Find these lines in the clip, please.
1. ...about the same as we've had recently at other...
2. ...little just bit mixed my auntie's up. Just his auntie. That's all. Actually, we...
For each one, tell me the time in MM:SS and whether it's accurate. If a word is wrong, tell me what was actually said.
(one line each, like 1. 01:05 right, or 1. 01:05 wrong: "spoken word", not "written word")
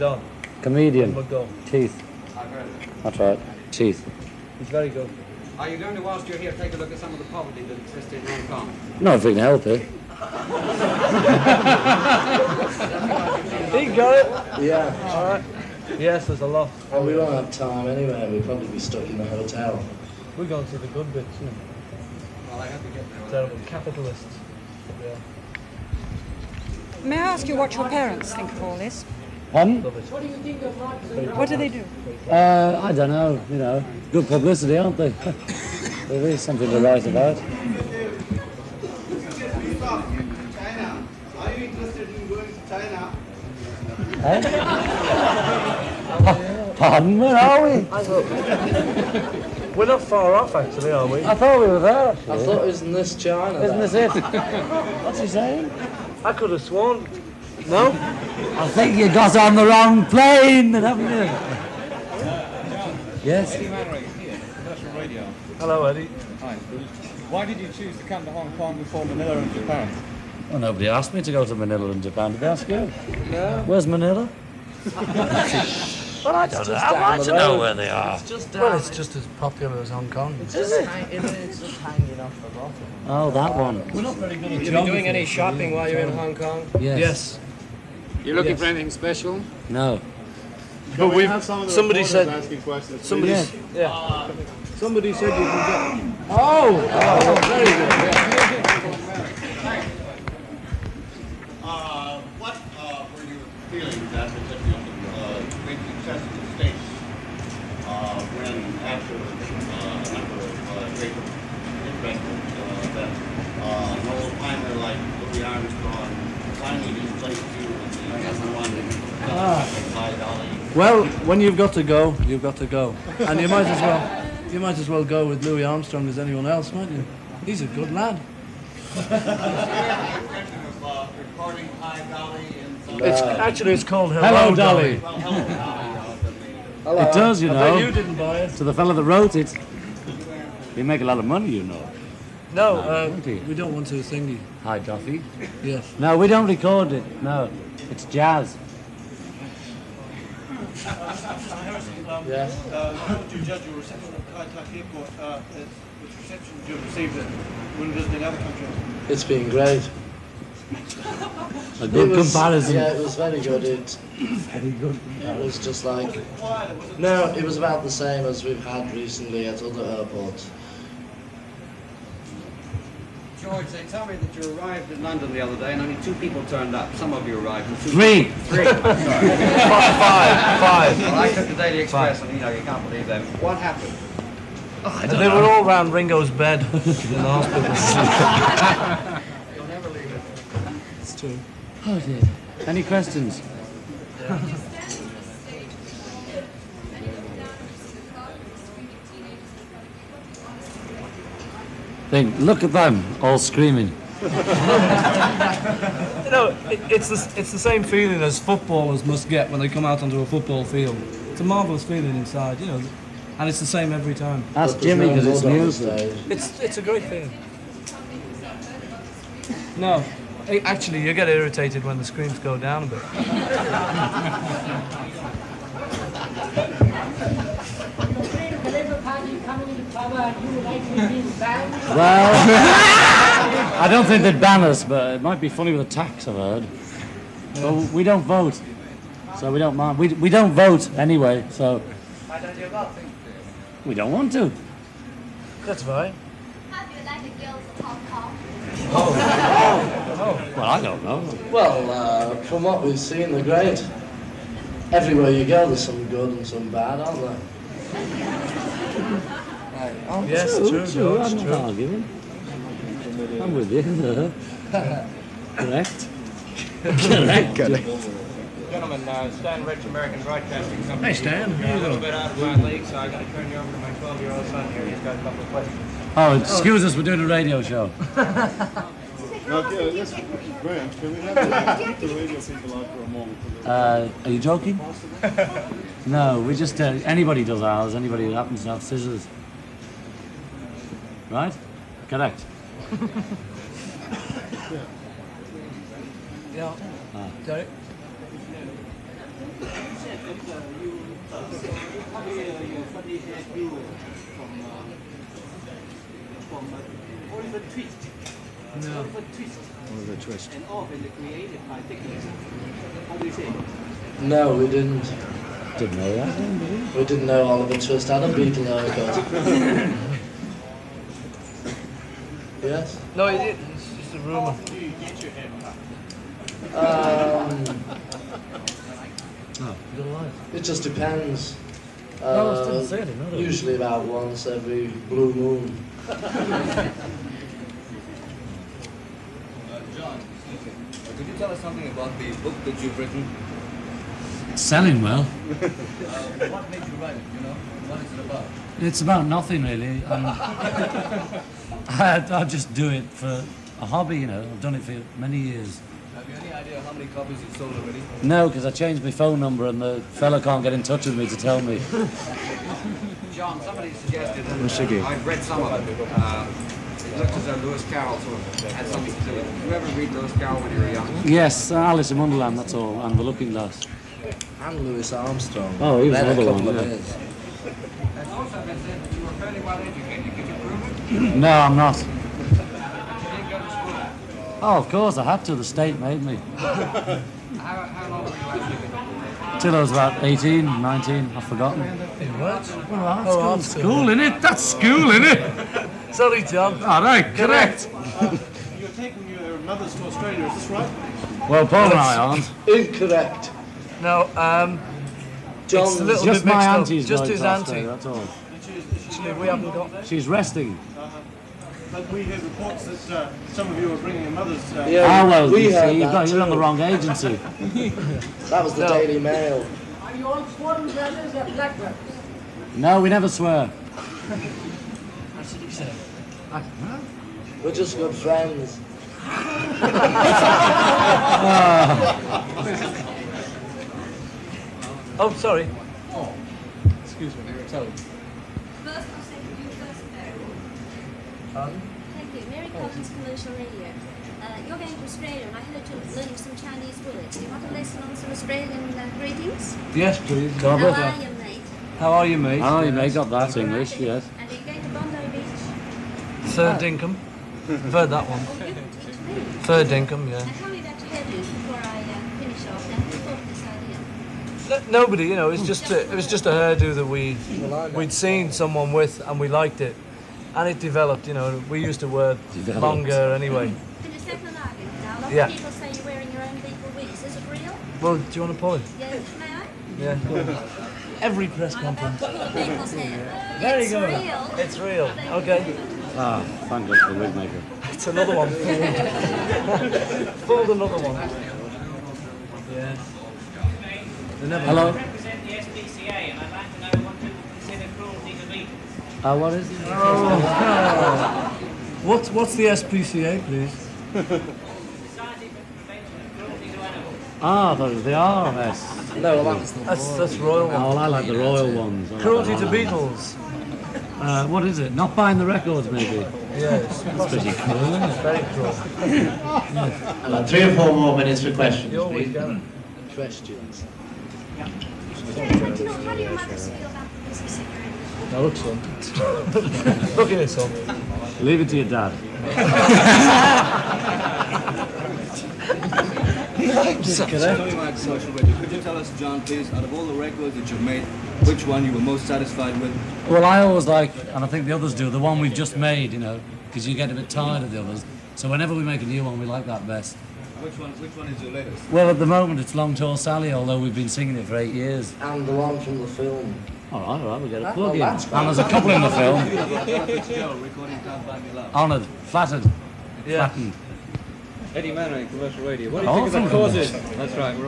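1. 02:47 right
2. 06:46 right.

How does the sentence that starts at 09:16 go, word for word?
All right, all right, we'll get a plug oh, in.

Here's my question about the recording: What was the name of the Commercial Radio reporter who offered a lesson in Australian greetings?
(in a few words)
Mary Collins.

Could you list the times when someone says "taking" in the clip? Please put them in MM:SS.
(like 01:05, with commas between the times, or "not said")
06:38.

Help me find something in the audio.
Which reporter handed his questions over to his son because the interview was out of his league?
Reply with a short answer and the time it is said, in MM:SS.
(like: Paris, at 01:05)
Stan Rich, at 04:29.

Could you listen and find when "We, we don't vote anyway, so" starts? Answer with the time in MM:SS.
03:59.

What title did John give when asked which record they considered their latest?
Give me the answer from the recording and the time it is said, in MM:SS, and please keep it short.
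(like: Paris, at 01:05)
Long Tall Sally, at 09:12.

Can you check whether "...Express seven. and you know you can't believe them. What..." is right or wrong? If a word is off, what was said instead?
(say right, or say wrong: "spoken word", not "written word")
wrong: "five", not "seven".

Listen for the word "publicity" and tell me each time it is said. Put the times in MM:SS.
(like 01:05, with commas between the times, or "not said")
00:34.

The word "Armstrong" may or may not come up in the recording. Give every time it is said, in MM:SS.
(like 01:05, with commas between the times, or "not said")
02:05, 06:15.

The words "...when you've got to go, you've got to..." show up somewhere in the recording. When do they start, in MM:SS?
02:01.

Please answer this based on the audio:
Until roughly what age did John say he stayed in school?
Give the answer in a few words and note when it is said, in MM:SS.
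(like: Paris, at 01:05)
18, at 06:30.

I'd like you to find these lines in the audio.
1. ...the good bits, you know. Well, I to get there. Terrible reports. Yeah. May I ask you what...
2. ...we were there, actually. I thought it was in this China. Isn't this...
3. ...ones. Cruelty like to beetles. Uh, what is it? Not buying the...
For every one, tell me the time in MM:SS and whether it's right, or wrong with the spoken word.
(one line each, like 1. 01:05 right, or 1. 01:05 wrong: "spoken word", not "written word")
1. 00:20 wrong: "capitalists", not "reports"
2. 00:51 right
3. 08:31 right.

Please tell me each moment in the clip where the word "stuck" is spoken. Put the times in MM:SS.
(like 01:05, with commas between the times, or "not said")
00:18.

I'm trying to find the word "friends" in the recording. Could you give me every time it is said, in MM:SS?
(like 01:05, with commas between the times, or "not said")
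07:08.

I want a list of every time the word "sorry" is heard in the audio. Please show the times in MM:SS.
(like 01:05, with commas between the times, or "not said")
06:36, 07:15.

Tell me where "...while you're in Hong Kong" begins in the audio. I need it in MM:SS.
01:25.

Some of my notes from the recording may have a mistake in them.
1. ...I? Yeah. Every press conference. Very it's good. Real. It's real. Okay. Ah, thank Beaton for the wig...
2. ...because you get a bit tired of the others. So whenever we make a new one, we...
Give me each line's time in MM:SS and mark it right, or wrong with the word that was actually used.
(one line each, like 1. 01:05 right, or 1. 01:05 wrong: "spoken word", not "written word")
1. 07:59 wrong: "God", not "Beaton"
2. 09:06 right.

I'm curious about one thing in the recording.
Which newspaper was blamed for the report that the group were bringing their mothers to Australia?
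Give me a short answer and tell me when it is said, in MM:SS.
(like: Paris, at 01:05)
Daily Mail, at 06:59.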